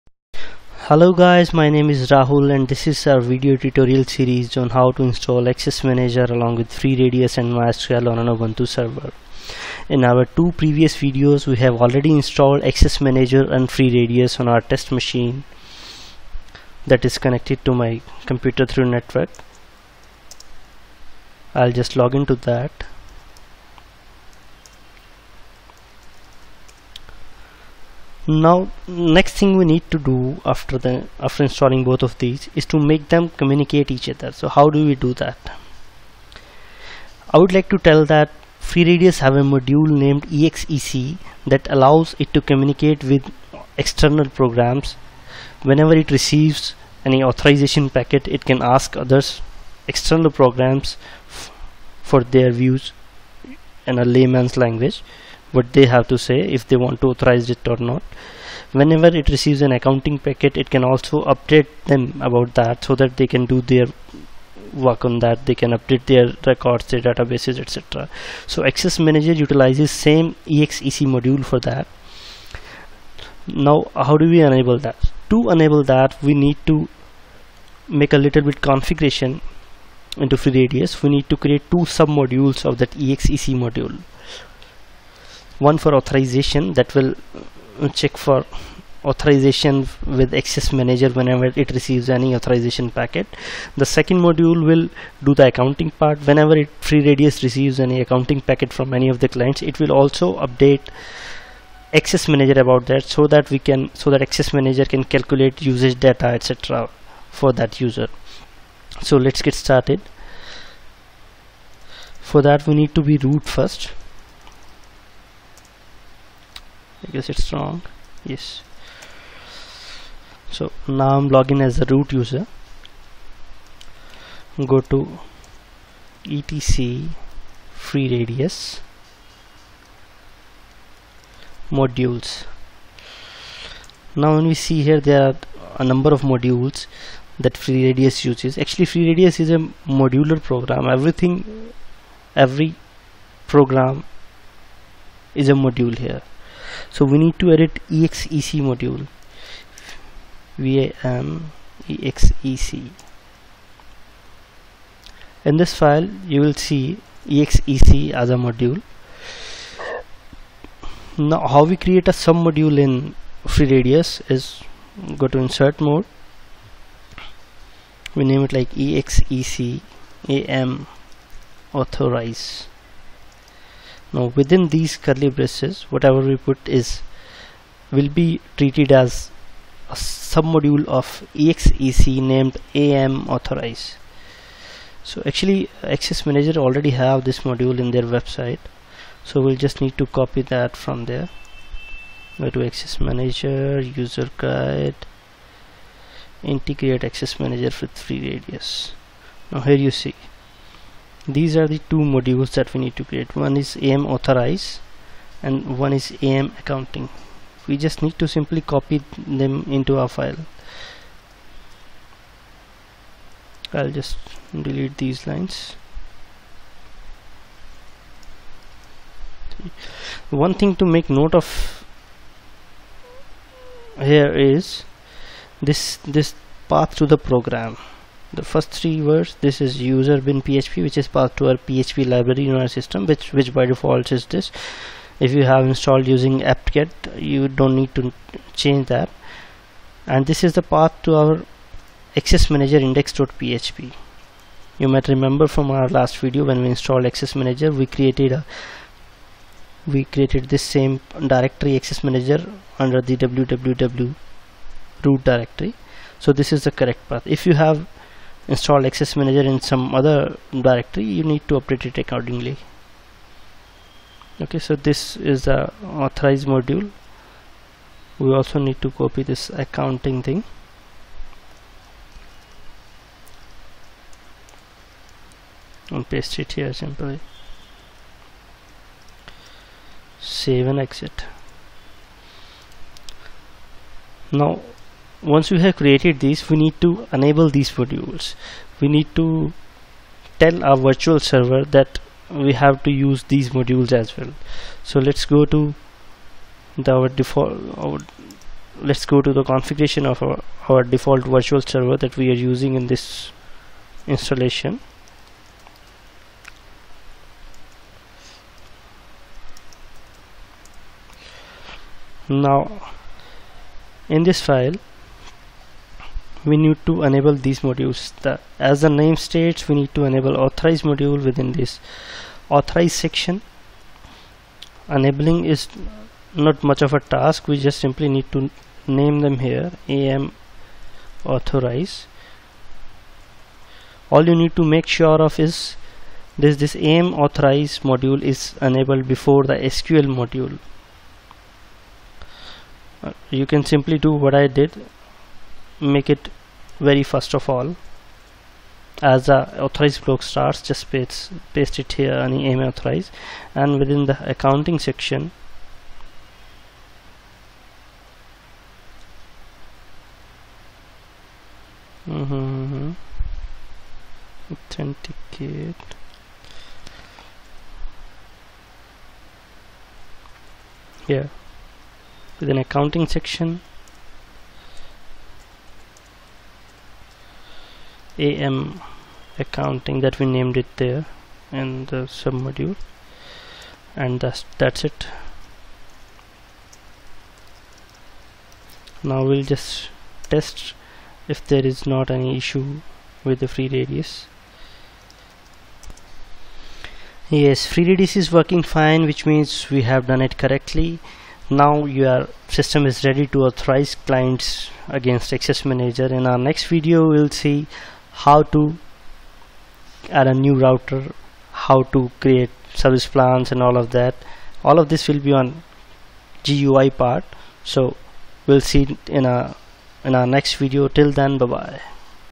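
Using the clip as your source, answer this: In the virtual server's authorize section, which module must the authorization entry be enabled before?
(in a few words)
sql.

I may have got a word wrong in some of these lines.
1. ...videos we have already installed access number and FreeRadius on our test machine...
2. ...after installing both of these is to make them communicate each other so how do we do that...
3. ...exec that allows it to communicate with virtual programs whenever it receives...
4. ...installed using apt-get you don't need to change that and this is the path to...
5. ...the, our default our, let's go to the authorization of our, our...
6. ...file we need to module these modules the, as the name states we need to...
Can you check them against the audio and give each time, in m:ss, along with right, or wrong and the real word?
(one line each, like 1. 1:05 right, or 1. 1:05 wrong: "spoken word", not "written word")
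1. 0:10 wrong: "manager", not "number"
2. 0:31 right
3. 0:40 wrong: "external", not "virtual"
4. 3:55 right
5. 4:56 wrong: "configuration", not "authorization"
6. 5:14 wrong: "enable", not "module".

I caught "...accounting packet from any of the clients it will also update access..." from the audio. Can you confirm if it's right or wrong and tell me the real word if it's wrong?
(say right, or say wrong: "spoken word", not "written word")
right.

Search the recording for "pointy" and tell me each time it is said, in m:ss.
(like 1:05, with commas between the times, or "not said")
not said.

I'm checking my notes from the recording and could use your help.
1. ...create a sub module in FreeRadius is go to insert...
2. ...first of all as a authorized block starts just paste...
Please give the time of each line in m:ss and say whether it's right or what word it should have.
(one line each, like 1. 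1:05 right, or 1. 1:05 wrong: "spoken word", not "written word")
1. 2:41 right
2. 5:47 right.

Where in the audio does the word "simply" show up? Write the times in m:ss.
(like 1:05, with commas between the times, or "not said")
3:28, 4:36, 5:27, 5:43.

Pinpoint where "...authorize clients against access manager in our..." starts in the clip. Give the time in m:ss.
6:43.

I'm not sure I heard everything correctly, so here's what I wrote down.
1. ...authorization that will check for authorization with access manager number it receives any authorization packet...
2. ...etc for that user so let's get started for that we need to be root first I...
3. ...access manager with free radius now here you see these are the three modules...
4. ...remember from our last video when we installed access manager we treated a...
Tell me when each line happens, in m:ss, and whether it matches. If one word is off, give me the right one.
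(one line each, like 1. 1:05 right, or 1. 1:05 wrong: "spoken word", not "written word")
1. 1:25 wrong: "whenever", not "number"
2. 1:46 right
3. 3:17 wrong: "two", not "three"
4. 4:05 wrong: "created", not "treated".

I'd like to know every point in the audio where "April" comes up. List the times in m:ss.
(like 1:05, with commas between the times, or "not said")
not said.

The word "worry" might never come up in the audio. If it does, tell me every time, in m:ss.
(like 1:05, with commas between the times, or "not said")
not said.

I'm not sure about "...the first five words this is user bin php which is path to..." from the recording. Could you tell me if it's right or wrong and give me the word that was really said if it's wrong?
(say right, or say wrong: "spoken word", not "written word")
wrong: "three", not "five".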